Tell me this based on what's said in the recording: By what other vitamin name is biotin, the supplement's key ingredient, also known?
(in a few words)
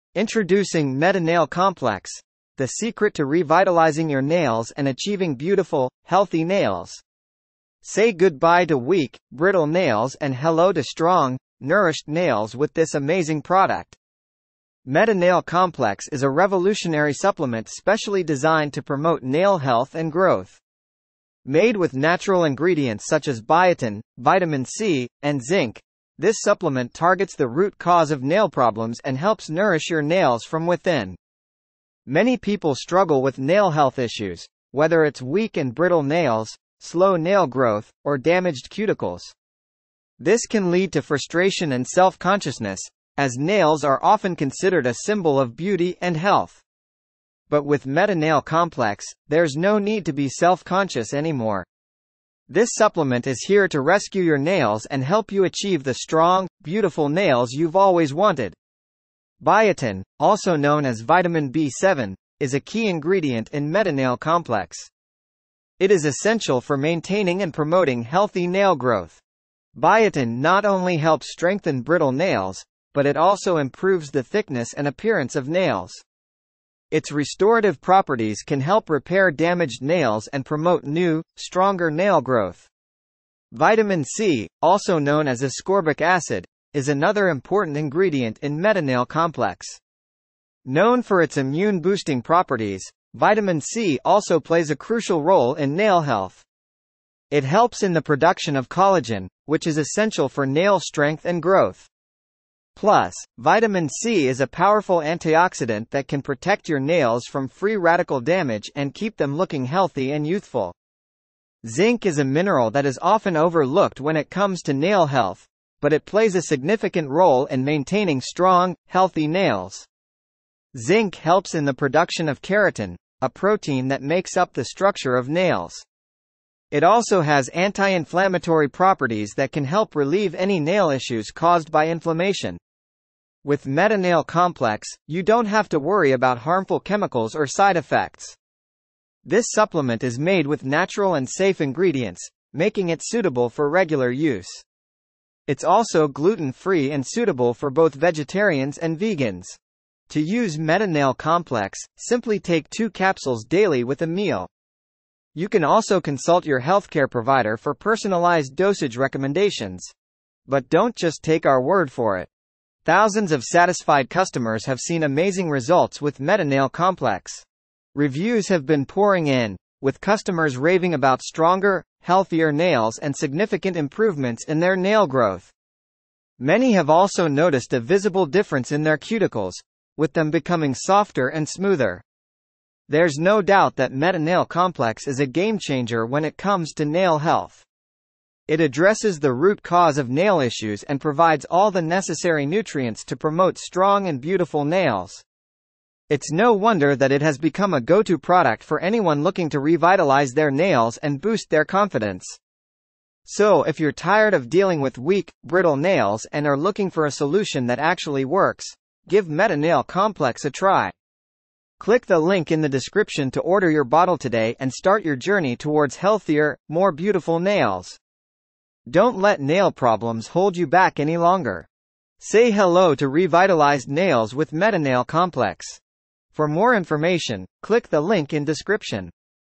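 vitamin B7.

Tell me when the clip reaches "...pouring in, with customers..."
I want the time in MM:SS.
02:48.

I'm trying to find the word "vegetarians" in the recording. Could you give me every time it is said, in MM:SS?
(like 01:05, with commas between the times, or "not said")
02:27.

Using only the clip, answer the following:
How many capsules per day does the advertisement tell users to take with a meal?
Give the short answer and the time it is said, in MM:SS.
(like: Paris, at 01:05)
2, at 02:32.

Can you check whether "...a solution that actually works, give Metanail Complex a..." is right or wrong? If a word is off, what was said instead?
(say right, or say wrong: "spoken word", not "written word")
right.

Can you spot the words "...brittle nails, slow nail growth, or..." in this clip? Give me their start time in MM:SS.
00:35.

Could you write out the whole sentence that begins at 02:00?
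Zinc helps in the production of keratin, a protein that makes up the structure of nails.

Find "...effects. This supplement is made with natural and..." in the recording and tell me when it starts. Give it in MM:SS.
02:17.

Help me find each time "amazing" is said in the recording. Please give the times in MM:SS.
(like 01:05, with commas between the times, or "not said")
00:12, 02:45.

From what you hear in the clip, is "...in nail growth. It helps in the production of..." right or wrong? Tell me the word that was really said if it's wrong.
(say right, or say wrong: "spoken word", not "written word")
wrong: "health", not "growth".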